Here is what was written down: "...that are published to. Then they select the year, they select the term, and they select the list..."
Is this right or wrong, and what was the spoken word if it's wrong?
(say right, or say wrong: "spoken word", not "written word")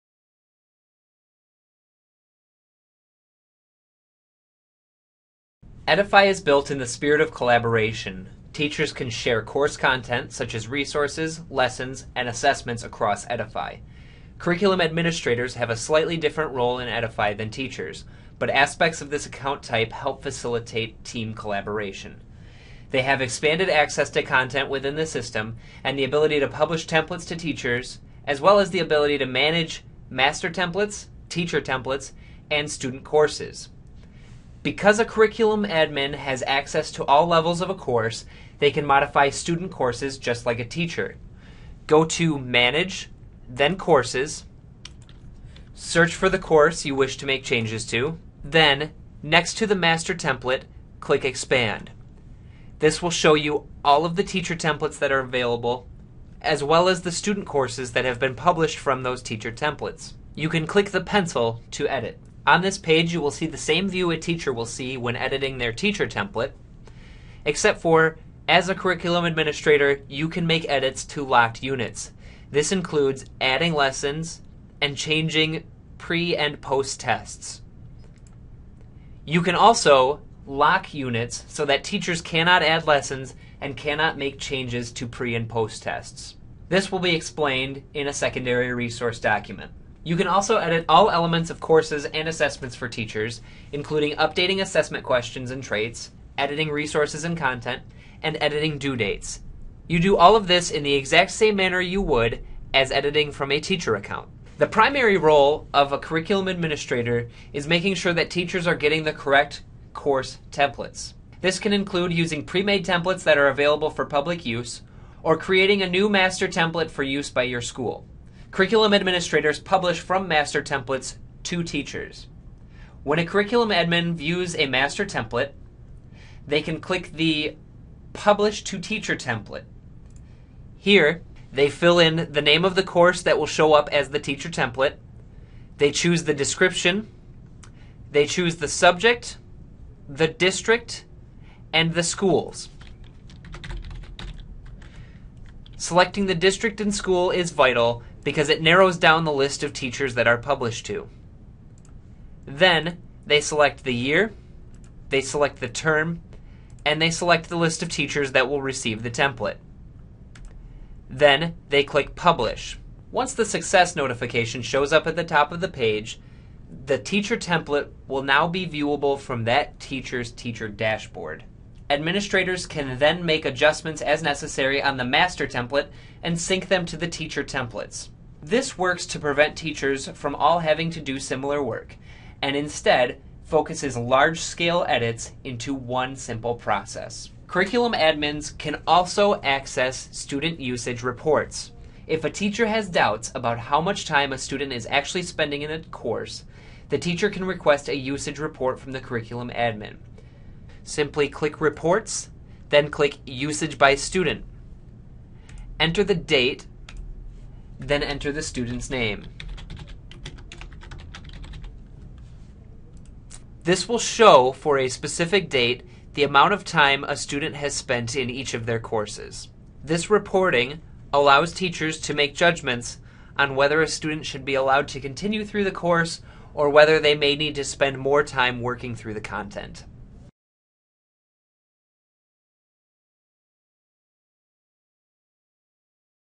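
right.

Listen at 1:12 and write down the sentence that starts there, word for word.
This includes adding lessons and changing pre and post tests.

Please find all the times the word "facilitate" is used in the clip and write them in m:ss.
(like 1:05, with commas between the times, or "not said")
0:20.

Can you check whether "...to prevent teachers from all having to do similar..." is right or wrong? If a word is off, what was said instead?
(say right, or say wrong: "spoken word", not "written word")
right.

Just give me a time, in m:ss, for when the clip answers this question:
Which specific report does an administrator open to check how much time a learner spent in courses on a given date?
3:23.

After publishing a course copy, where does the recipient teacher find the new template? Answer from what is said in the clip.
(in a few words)
Teacher dashboard.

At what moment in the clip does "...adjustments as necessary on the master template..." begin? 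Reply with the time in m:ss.
2:53.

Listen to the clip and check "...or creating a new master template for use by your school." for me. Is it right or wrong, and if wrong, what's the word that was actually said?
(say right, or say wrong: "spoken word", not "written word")
right.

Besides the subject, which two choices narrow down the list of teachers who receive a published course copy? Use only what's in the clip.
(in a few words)
The district and the schools.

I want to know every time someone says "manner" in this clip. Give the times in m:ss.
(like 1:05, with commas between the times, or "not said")
1:41.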